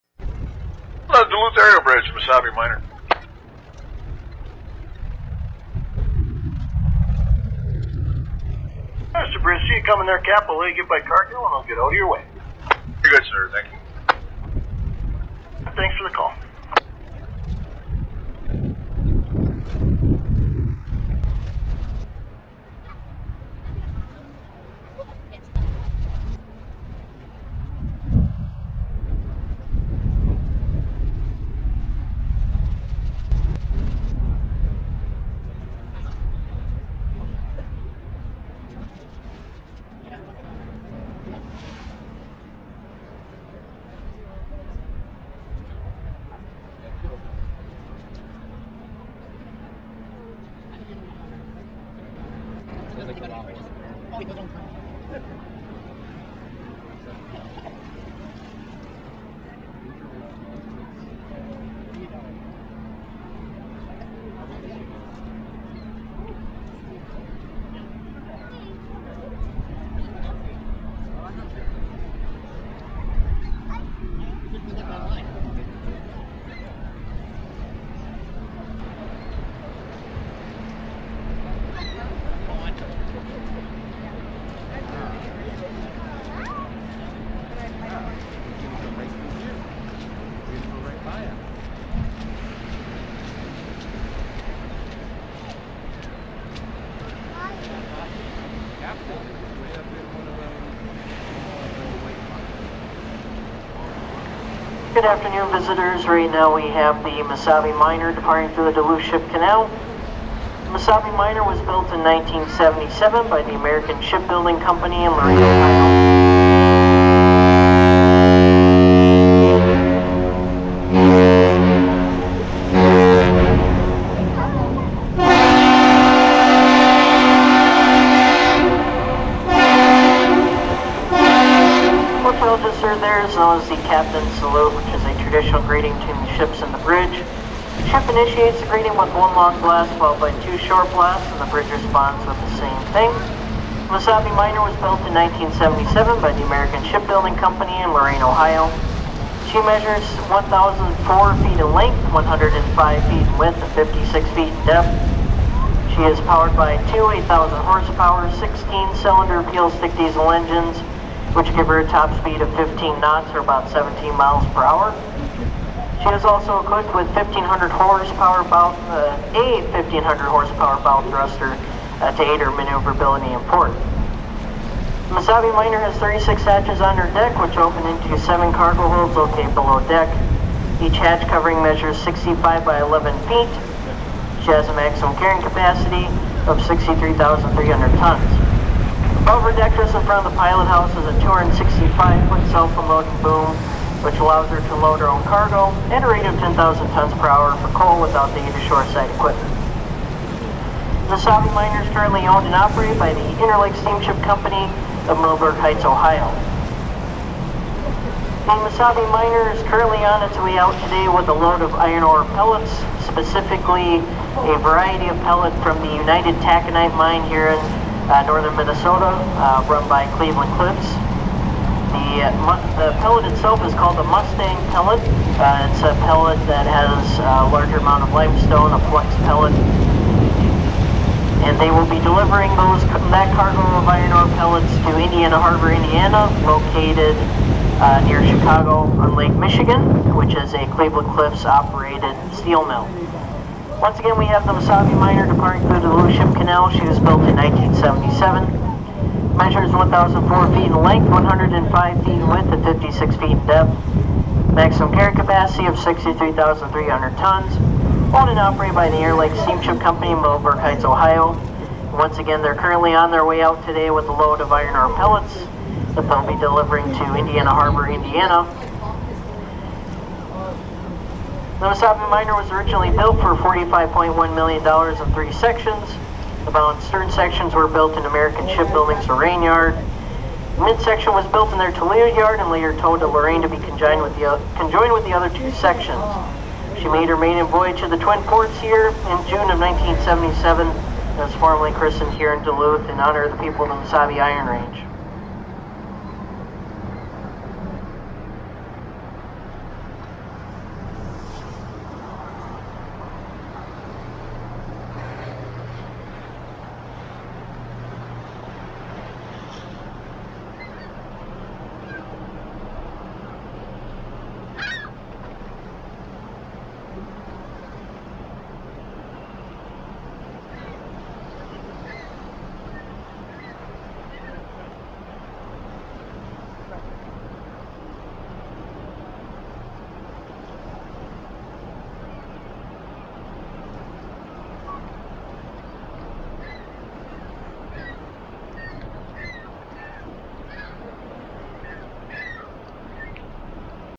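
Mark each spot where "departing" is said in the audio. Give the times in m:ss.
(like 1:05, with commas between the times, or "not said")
1:48, 4:05.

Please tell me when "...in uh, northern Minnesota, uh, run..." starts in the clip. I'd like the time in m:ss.
3:37.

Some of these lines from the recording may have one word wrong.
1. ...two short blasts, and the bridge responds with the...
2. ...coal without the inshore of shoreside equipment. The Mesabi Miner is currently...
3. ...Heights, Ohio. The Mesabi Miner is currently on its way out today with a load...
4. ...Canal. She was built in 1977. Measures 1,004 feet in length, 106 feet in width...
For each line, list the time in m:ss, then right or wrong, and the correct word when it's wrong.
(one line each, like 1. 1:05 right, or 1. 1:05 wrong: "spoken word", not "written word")
1. 2:20 right
2. 3:17 right
3. 3:25 right
4. 4:06 wrong: "105", not "106".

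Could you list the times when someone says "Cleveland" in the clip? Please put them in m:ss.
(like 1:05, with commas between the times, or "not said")
3:40, 4:00.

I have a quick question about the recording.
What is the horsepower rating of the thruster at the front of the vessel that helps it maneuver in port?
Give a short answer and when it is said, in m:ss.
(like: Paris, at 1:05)
1500, at 2:49.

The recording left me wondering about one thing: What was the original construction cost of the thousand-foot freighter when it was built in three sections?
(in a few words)
$45.1 million.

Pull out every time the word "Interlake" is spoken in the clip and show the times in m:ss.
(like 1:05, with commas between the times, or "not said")
3:23, 4:19.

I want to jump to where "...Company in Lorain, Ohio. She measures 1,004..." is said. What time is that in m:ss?
2:27.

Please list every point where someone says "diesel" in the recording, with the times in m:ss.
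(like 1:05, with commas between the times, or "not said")
2:39.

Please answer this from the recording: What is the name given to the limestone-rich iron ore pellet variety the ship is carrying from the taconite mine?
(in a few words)
Mustang pellet.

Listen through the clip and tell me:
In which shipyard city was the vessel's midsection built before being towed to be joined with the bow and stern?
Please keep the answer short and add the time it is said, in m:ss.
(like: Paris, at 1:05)
Toledo, at 4:41.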